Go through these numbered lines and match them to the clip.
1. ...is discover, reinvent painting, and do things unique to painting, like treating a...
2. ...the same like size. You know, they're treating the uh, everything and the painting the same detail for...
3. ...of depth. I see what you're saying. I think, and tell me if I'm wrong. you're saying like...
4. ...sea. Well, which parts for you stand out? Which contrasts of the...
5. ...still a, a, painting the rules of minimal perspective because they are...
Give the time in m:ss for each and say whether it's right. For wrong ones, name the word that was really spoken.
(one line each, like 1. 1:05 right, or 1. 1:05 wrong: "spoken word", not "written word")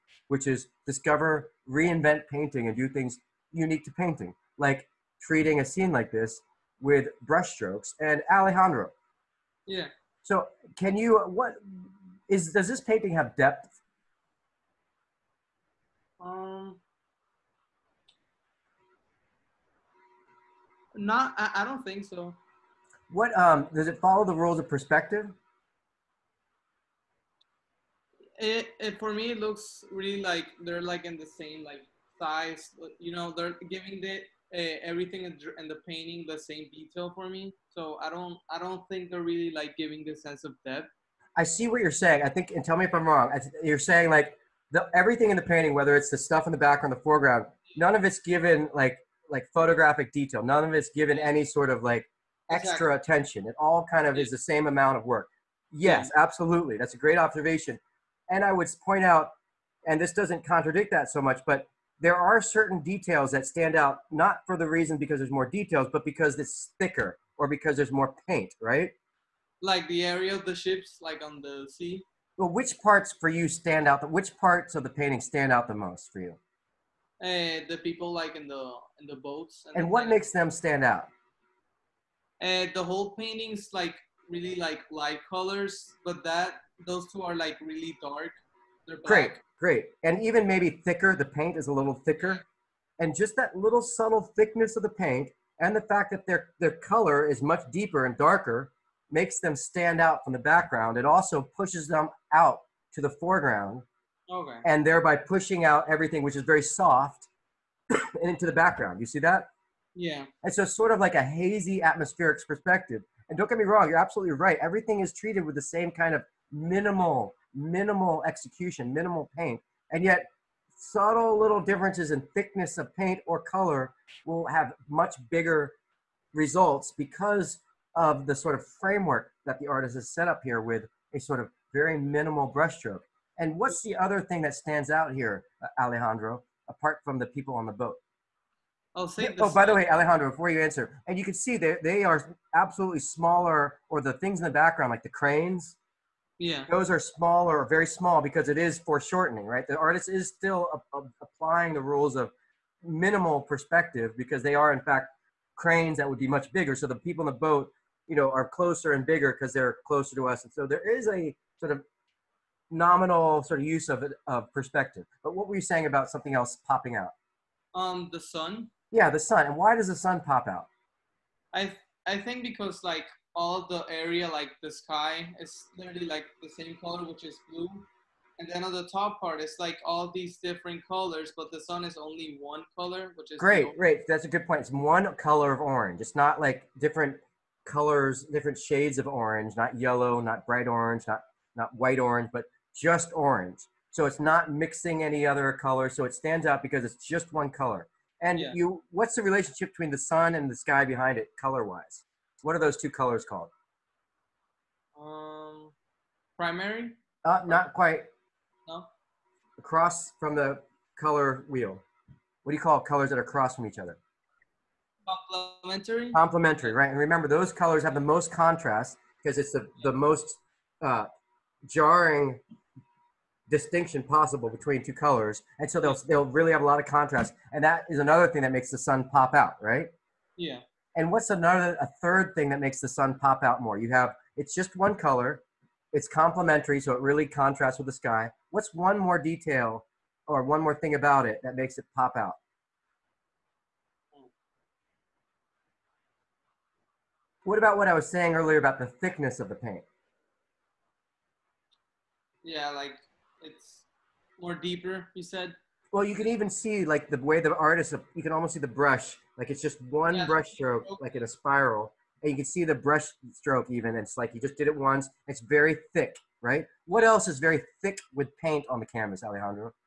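1. 0:00 right
2. 0:31 wrong: "giving", not "treating"
3. 0:40 right
4. 1:11 wrong: "parts", not "contrasts"
5. 2:30 wrong: "applying", not "painting".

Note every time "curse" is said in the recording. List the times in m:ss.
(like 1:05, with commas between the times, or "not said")
not said.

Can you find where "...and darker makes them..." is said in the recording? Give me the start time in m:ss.
1:38.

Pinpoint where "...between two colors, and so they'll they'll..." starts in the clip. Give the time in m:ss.
3:44.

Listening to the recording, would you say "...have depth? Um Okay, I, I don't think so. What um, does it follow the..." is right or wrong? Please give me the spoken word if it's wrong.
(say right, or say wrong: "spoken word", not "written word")
wrong: "Not", not "Okay".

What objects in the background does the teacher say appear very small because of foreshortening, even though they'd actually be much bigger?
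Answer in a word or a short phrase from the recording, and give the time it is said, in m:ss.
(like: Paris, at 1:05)
the cranes, at 2:25.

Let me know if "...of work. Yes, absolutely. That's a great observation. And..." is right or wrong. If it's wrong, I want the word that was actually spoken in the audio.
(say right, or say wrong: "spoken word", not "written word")
right.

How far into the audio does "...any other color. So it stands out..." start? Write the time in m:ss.
3:15.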